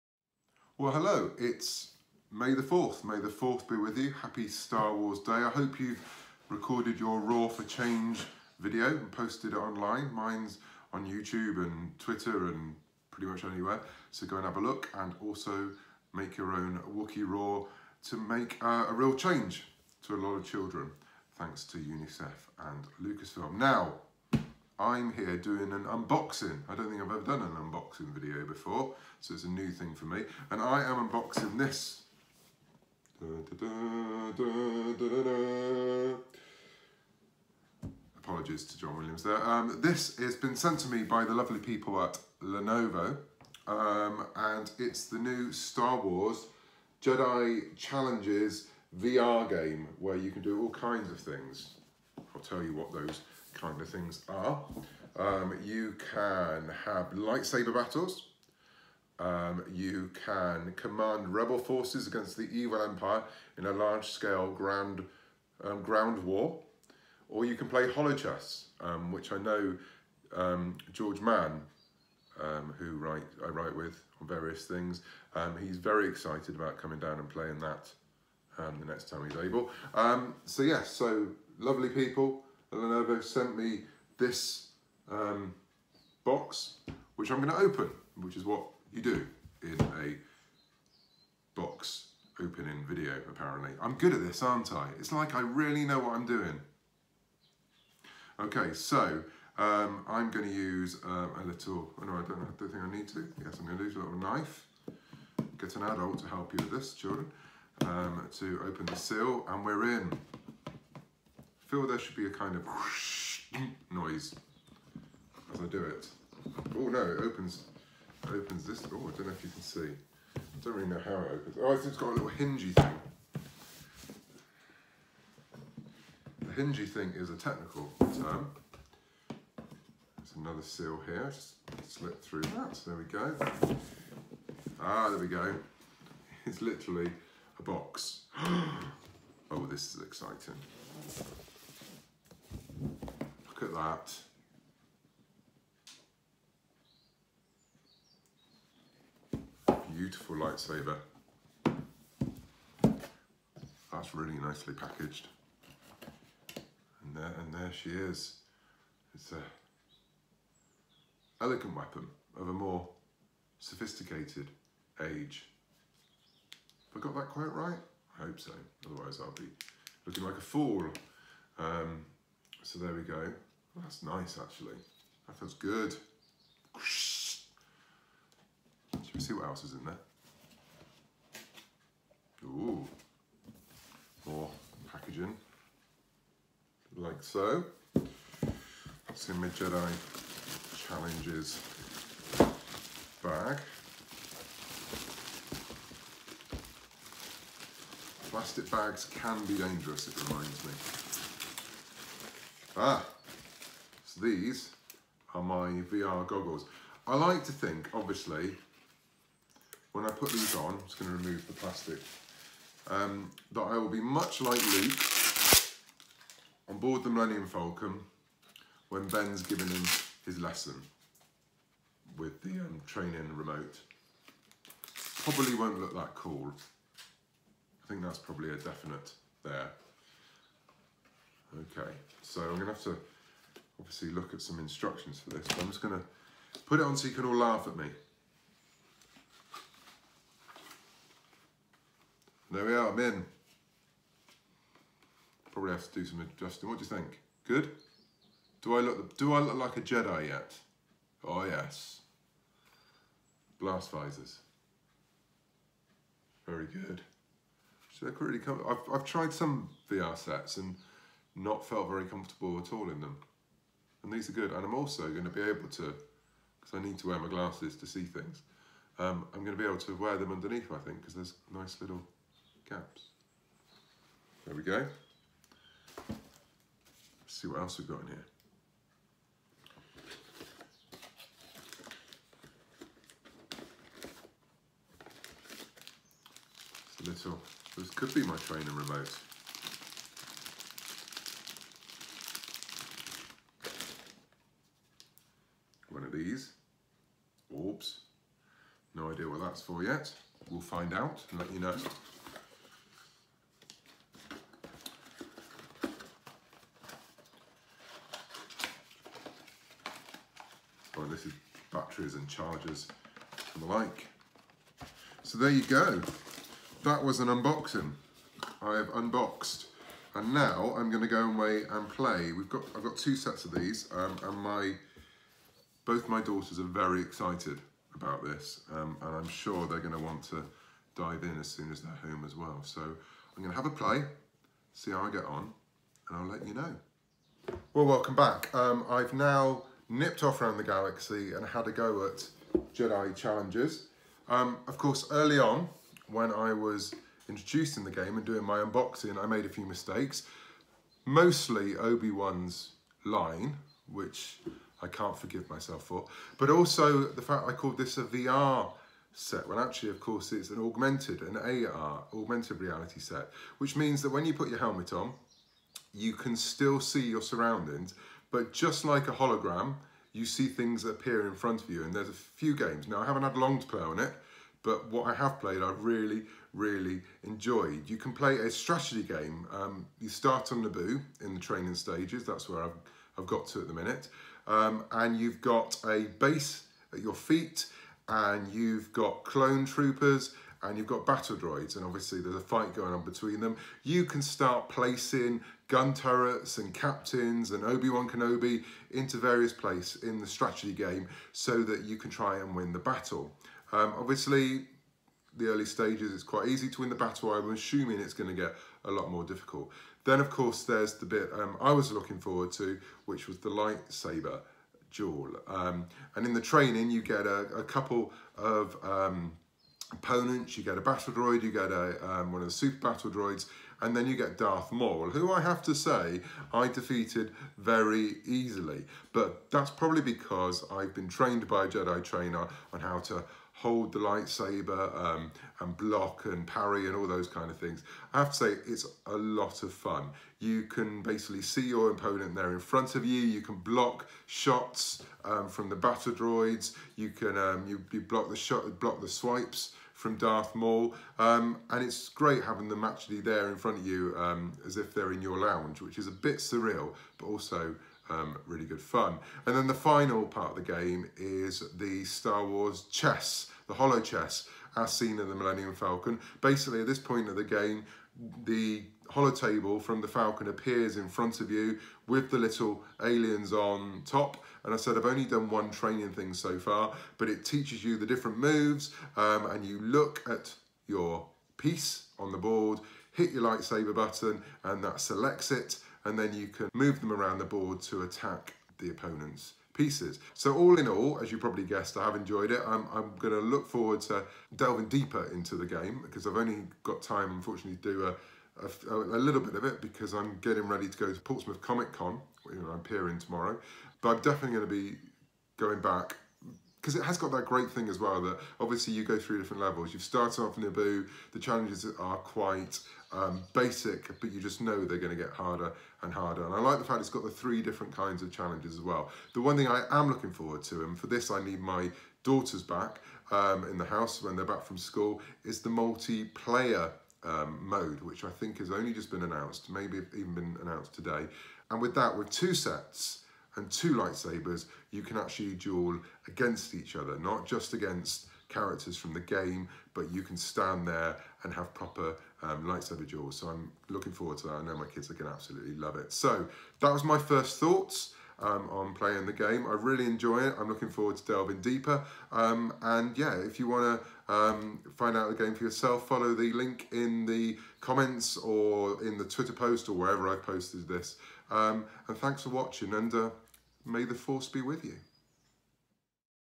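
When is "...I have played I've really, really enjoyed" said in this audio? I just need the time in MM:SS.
06:15.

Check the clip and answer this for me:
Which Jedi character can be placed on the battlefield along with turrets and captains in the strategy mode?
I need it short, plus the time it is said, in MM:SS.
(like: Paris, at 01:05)
Obi-Wan Kenobi, at 06:37.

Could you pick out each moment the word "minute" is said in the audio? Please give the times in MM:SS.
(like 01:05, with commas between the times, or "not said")
06:23.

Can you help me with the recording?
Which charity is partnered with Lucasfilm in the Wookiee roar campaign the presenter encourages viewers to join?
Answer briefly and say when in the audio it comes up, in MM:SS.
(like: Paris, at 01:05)
UNICEF, at 00:21.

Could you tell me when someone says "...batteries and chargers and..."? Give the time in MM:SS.
05:11.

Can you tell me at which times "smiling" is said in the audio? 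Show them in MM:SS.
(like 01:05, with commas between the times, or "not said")
not said.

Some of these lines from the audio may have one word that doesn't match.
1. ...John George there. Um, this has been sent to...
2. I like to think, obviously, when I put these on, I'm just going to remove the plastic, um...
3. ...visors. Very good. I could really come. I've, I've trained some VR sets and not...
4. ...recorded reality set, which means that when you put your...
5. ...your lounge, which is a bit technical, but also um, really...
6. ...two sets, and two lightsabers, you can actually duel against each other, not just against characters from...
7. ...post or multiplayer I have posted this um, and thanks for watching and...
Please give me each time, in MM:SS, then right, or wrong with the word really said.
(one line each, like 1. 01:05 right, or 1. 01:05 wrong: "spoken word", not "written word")
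1. 00:38 wrong: "Williams", not "George"
2. 03:27 right
3. 04:13 wrong: "tried", not "trained"
4. 06:02 wrong: "augmented", not "recorded"
5. 07:35 wrong: "surreal", not "technical"
6. 08:52 right
7. 09:19 wrong: "wherever", not "multiplayer".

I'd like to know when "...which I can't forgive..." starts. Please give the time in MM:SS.
05:53.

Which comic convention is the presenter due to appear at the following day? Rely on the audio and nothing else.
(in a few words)
Portsmouth Comic Con.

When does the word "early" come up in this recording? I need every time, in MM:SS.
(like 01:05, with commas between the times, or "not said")
05:45, 06:45.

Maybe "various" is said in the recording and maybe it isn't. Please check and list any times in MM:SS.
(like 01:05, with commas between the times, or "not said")
01:14, 06:39.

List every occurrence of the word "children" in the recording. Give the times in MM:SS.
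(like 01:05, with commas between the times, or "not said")
00:20, 01:46.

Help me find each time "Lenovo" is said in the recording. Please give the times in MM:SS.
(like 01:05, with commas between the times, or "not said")
00:42, 01:22.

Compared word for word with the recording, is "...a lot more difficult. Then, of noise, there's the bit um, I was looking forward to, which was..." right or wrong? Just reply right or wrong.
wrong.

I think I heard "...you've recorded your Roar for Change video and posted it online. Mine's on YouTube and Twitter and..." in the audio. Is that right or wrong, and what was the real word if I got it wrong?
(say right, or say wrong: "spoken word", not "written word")
right.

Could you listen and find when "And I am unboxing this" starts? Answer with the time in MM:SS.
00:30.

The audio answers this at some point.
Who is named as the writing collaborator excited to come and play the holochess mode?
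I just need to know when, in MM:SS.
01:10.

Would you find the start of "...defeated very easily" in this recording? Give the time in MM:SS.
07:06.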